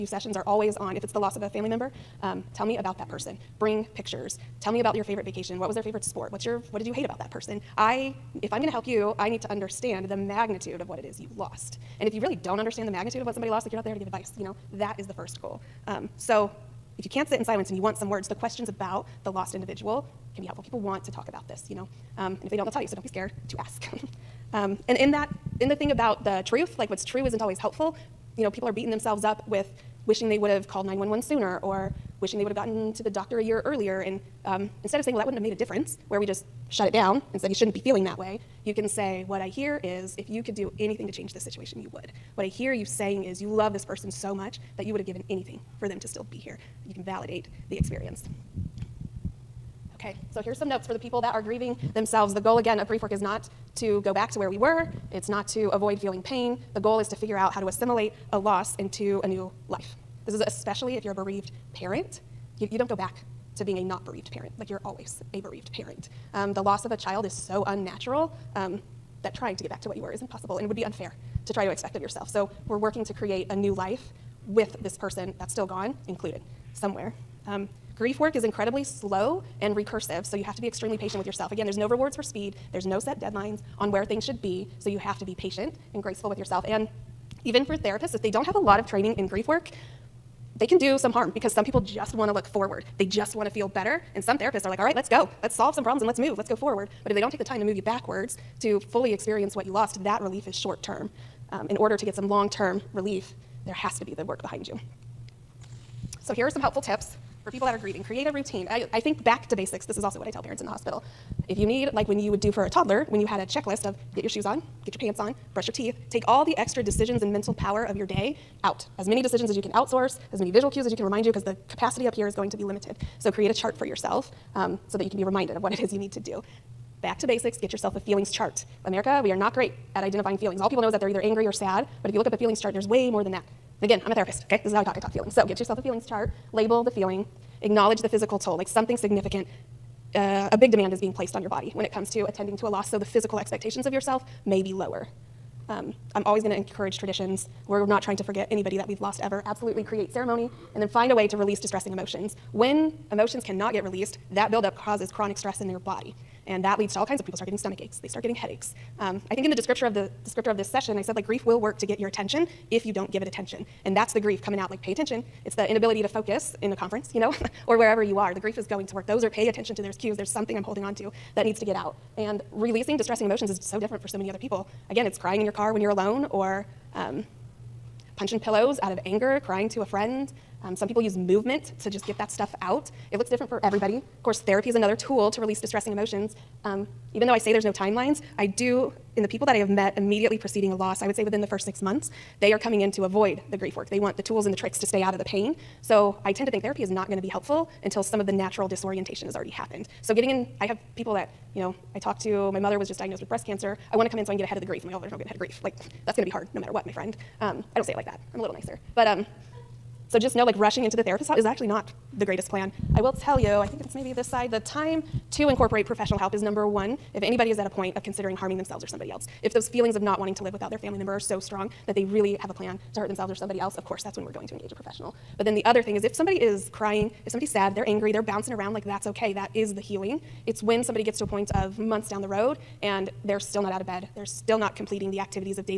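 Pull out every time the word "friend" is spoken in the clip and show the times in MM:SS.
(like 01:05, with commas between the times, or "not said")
02:59, 03:26.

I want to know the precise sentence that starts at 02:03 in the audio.
So create a chart for yourself um, so that you can be reminded of what it is you need to do.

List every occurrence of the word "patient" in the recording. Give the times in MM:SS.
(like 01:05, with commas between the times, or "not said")
01:20, 01:25.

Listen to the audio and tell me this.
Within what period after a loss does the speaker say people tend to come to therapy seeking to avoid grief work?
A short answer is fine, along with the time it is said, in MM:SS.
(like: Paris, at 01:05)
6 months, at 03:11.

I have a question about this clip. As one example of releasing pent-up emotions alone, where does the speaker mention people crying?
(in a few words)
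in your car.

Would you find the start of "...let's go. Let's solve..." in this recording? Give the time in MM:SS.
01:34.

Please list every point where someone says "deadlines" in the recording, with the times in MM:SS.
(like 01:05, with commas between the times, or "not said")
01:23.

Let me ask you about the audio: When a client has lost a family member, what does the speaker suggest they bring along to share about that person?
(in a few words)
pictures.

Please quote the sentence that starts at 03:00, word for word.
Um, some people use movement to just get that stuff out.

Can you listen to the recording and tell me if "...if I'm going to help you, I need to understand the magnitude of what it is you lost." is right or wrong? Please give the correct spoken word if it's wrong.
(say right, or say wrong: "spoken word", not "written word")
right.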